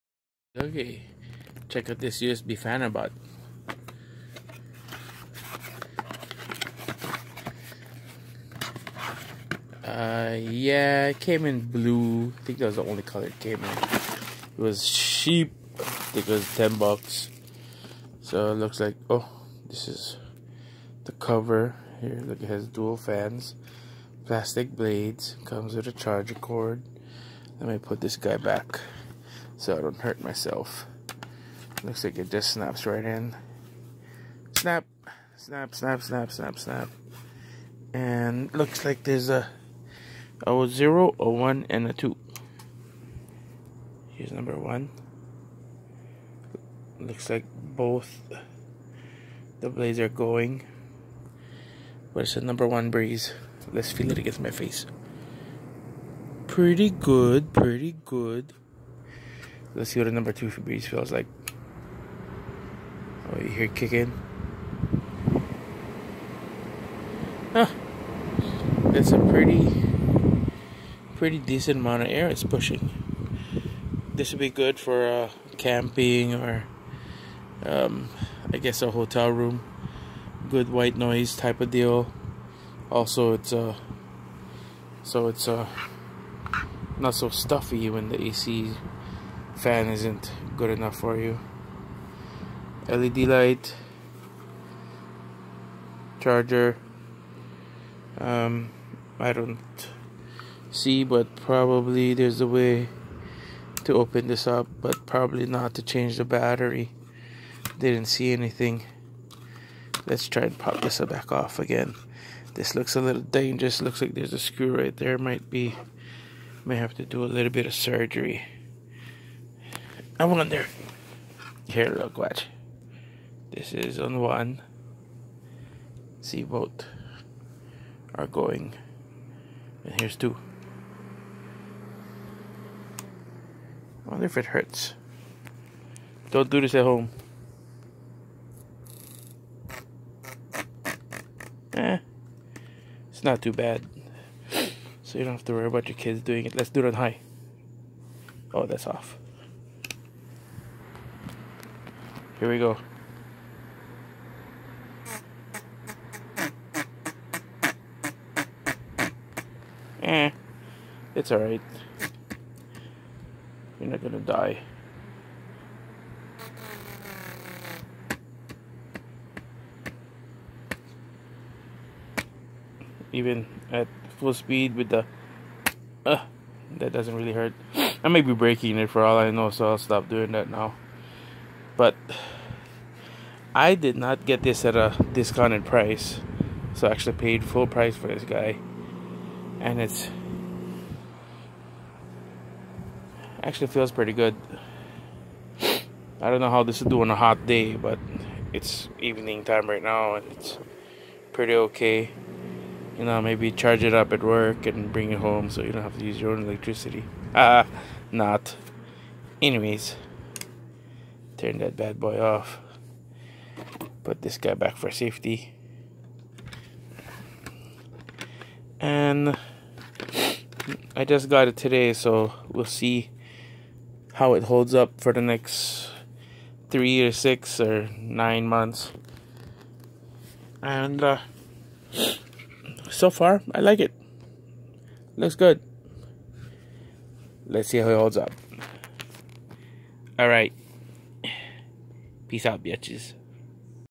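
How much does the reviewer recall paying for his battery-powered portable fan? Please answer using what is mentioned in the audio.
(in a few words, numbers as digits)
$10.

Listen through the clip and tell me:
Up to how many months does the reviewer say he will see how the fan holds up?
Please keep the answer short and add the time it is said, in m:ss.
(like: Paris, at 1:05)
9, at 3:47.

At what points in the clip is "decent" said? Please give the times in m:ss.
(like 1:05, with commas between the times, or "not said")
1:11.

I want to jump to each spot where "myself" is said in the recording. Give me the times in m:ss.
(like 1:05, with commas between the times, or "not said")
0:30.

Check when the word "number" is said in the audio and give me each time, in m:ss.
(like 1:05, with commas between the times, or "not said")
0:44, 0:52, 1:00.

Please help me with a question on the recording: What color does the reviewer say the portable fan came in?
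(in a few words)
Blue.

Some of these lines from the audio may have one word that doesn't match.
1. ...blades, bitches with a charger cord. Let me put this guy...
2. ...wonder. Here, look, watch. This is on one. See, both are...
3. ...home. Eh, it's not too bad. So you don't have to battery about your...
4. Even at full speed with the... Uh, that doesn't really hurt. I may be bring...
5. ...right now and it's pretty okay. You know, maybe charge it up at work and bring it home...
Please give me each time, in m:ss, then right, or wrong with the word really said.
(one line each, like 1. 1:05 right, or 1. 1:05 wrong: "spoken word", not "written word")
1. 0:24 wrong: "comes", not "bitches"
2. 2:00 right
3. 2:16 wrong: "worry", not "battery"
4. 2:53 wrong: "breaking", not "bring"
5. 3:19 right.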